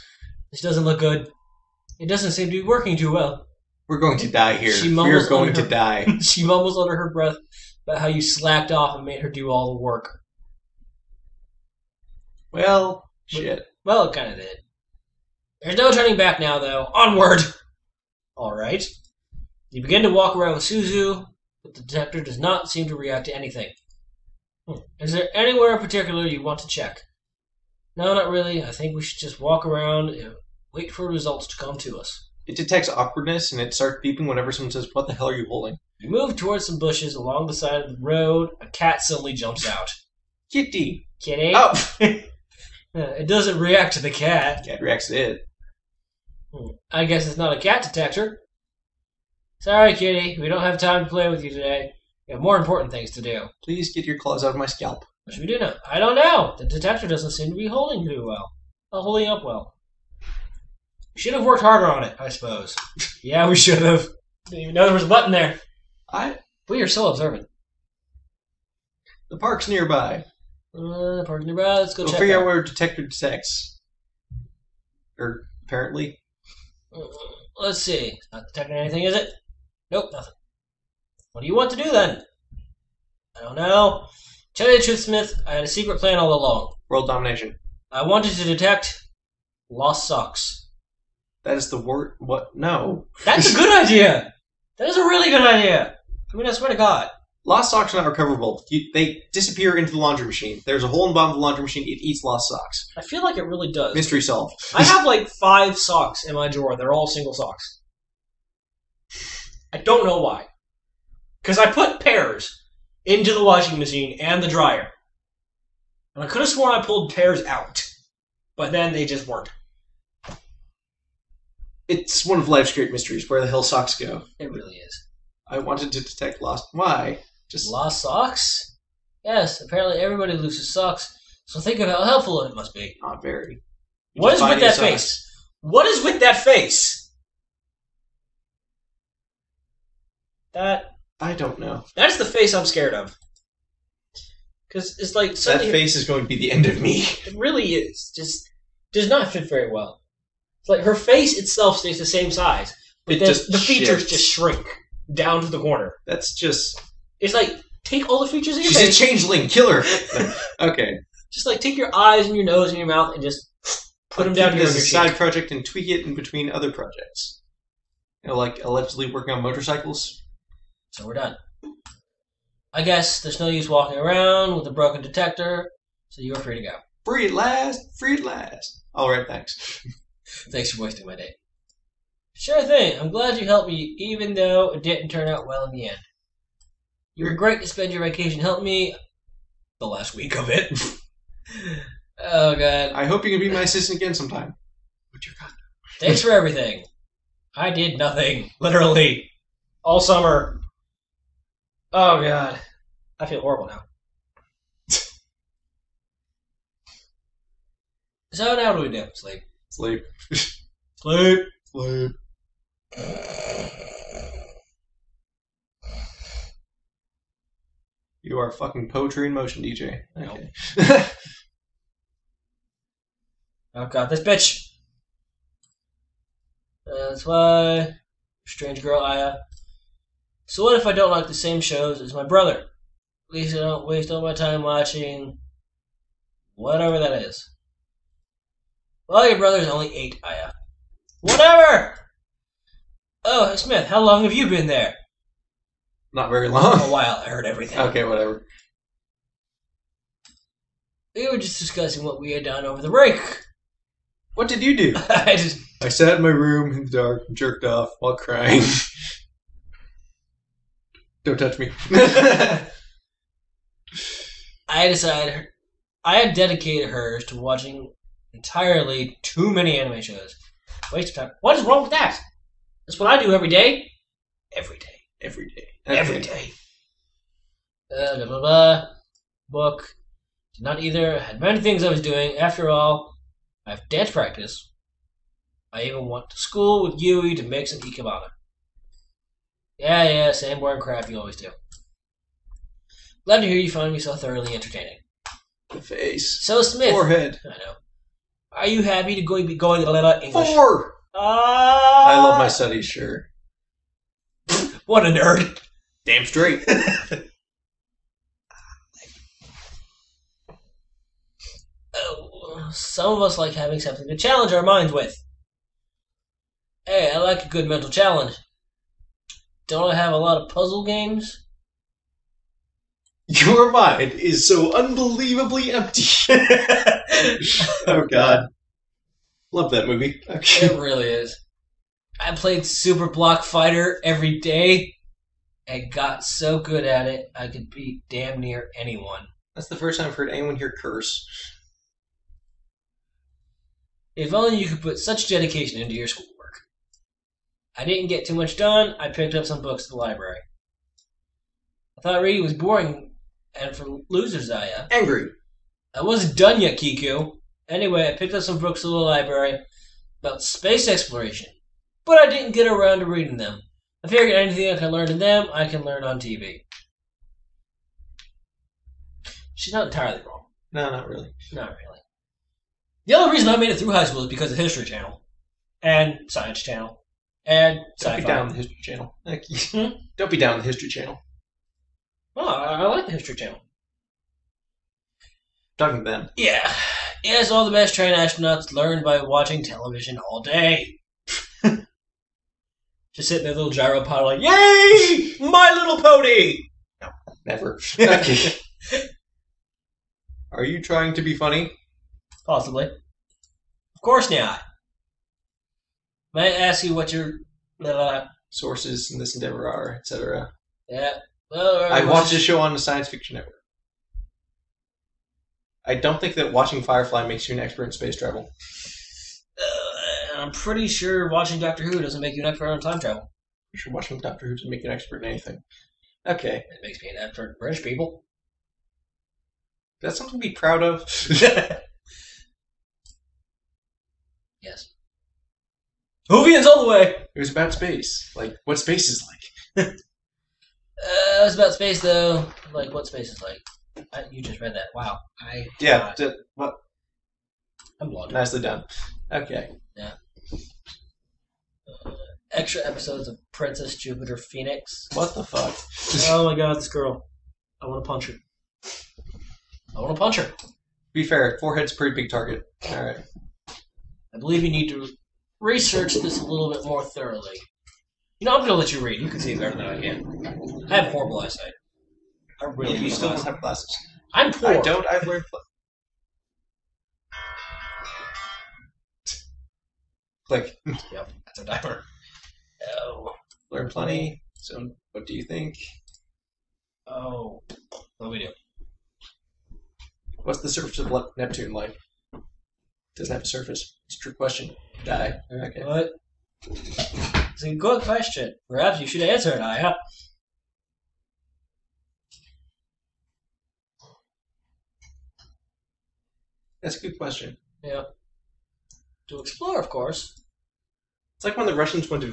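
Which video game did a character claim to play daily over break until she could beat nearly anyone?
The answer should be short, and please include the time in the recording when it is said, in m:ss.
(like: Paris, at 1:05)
Super Block Fighter, at 5:32.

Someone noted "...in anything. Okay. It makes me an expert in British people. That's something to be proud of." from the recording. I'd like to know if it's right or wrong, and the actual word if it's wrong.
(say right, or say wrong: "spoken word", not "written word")
right.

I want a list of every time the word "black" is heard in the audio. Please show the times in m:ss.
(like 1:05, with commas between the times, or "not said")
not said.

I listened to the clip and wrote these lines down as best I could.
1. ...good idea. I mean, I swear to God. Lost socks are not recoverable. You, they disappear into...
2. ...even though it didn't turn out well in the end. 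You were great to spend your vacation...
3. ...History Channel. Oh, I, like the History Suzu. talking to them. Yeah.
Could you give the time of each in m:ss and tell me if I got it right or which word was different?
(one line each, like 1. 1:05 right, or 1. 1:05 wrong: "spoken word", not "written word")
1. 1:35 right
2. 3:03 right
3. 6:20 wrong: "Channel", not "Suzu".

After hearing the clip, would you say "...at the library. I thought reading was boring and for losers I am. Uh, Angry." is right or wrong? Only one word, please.
right.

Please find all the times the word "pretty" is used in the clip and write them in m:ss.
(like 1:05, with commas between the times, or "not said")
7:00, 7:41.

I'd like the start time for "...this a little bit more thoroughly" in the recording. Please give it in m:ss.
7:46.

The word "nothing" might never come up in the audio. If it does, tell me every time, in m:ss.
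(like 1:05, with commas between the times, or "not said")
1:20, 3:17.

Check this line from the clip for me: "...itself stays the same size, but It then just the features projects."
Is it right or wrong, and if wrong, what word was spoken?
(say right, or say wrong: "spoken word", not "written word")
wrong: "shifts", not "projects".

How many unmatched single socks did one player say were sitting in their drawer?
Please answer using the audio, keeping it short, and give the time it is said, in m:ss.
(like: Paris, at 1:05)
5, at 1:45.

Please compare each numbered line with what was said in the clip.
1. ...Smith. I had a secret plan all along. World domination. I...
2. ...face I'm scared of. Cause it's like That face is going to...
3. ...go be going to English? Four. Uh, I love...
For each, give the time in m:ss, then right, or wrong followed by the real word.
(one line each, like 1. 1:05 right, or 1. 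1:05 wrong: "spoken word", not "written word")
1. 1:25 right
2. 2:22 right
3. 4:59 right.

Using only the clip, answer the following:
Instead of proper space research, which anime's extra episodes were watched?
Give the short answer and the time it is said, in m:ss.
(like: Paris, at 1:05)
Princess Jupiter Phoenix, at 7:33.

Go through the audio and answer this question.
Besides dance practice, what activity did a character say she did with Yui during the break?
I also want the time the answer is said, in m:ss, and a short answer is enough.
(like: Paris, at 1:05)
Ikebana, at 4:47.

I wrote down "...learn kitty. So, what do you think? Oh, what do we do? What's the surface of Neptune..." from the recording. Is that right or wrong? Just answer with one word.
wrong.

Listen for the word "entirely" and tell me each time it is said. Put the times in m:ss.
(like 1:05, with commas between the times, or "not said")
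4:28, 6:09.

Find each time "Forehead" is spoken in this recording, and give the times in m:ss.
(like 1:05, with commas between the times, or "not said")
4:56, 7:41.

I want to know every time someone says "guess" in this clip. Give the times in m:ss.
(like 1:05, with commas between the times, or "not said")
0:47, 2:52.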